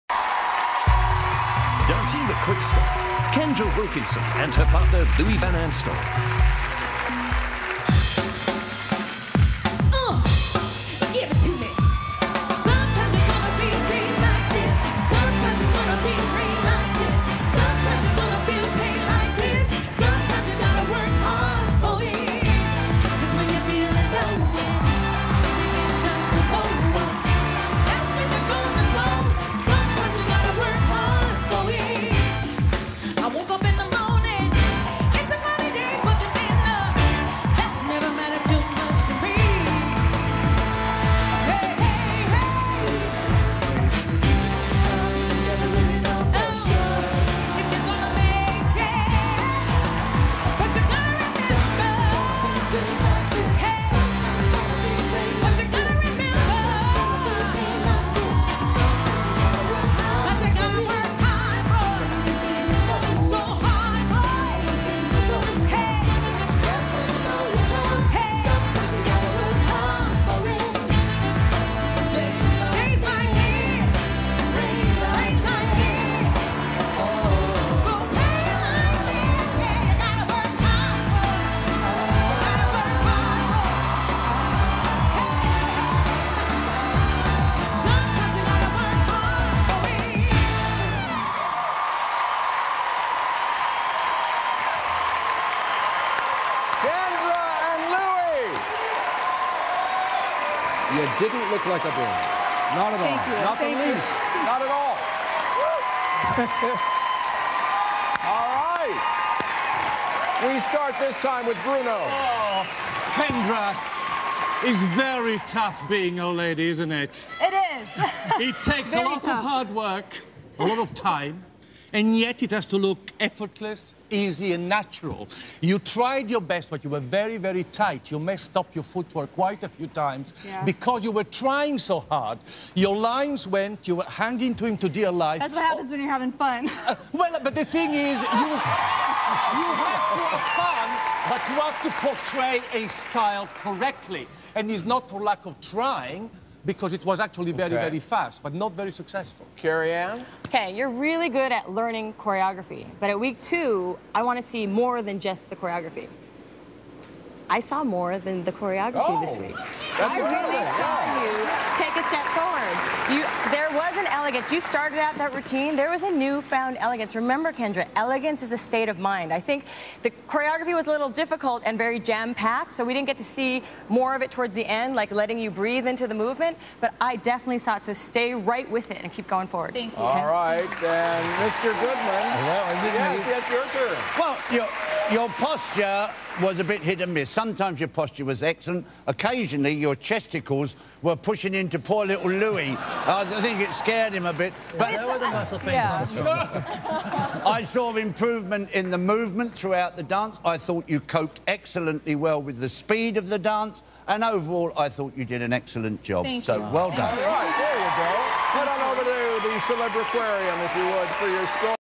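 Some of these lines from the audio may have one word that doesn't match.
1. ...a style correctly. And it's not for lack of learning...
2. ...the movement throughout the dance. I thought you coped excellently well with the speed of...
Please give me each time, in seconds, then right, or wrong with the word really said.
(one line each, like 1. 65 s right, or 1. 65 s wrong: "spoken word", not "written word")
1. 142 s wrong: "trying", not "learning"
2. 198 s right.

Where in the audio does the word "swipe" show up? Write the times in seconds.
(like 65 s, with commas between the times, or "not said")
not said.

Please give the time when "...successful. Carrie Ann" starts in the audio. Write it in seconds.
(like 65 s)
148 s.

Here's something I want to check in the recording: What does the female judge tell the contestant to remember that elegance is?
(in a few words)
a state of mind.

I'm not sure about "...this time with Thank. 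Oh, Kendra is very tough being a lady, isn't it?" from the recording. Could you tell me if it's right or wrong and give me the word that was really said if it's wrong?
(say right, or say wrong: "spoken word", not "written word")
wrong: "Bruno", not "Thank".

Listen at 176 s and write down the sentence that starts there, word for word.
But I definitely saw it, so stay right with it and keep going forward.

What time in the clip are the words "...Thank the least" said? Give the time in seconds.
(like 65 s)
103 s.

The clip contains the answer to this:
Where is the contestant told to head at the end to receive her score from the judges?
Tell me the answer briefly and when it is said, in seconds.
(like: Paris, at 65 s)
the Celebriquarium, at 209 s.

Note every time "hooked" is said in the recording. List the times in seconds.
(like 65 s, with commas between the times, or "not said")
not said.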